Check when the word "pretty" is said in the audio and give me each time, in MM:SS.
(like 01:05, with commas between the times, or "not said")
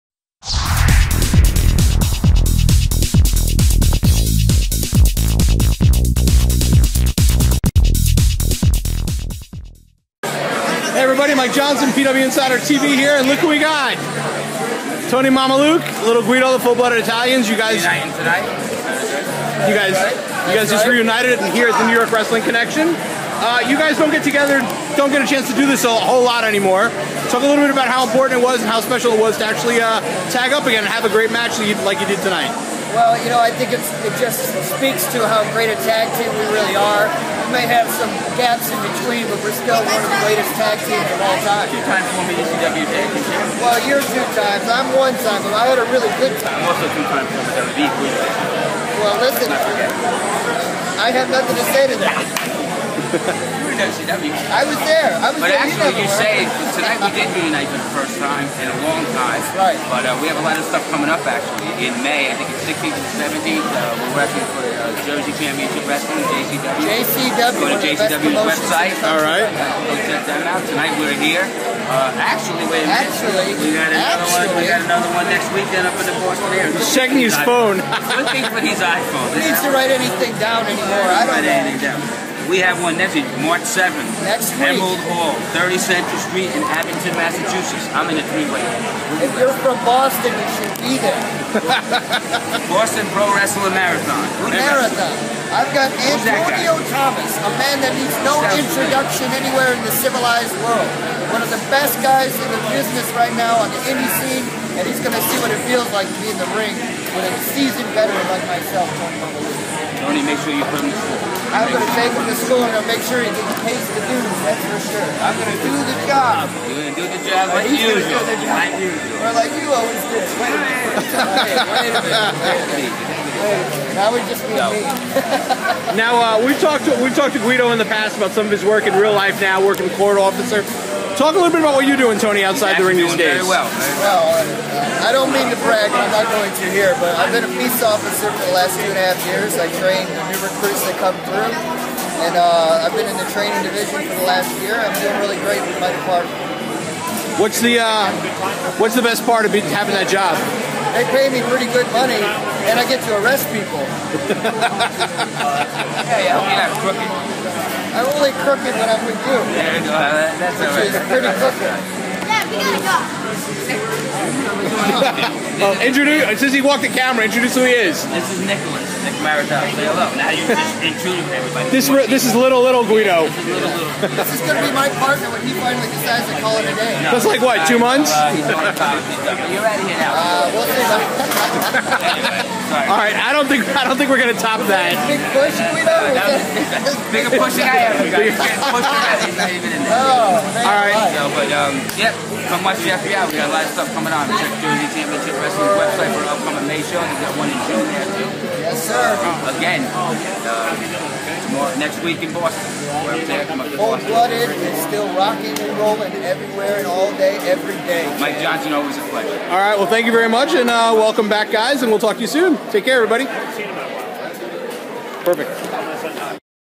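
02:31, 02:41.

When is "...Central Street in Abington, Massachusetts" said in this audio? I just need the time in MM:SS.
01:25.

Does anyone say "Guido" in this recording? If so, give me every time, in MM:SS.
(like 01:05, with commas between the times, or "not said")
00:16, 02:07, 02:52, 03:05.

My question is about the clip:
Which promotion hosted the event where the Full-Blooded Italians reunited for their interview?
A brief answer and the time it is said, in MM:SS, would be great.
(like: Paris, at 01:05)
New York Wrestling Connection, at 00:21.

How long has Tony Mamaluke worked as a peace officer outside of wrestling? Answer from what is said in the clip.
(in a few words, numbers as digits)
2.5 years.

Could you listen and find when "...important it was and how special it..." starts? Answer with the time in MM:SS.
00:28.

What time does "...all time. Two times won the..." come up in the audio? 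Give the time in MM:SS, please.
00:41.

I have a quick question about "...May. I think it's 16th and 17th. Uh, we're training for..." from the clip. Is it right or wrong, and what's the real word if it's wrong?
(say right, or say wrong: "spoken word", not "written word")
wrong: "wrestling", not "training".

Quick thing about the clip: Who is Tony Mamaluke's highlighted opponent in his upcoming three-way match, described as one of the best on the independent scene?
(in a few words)
Antonio Thomas.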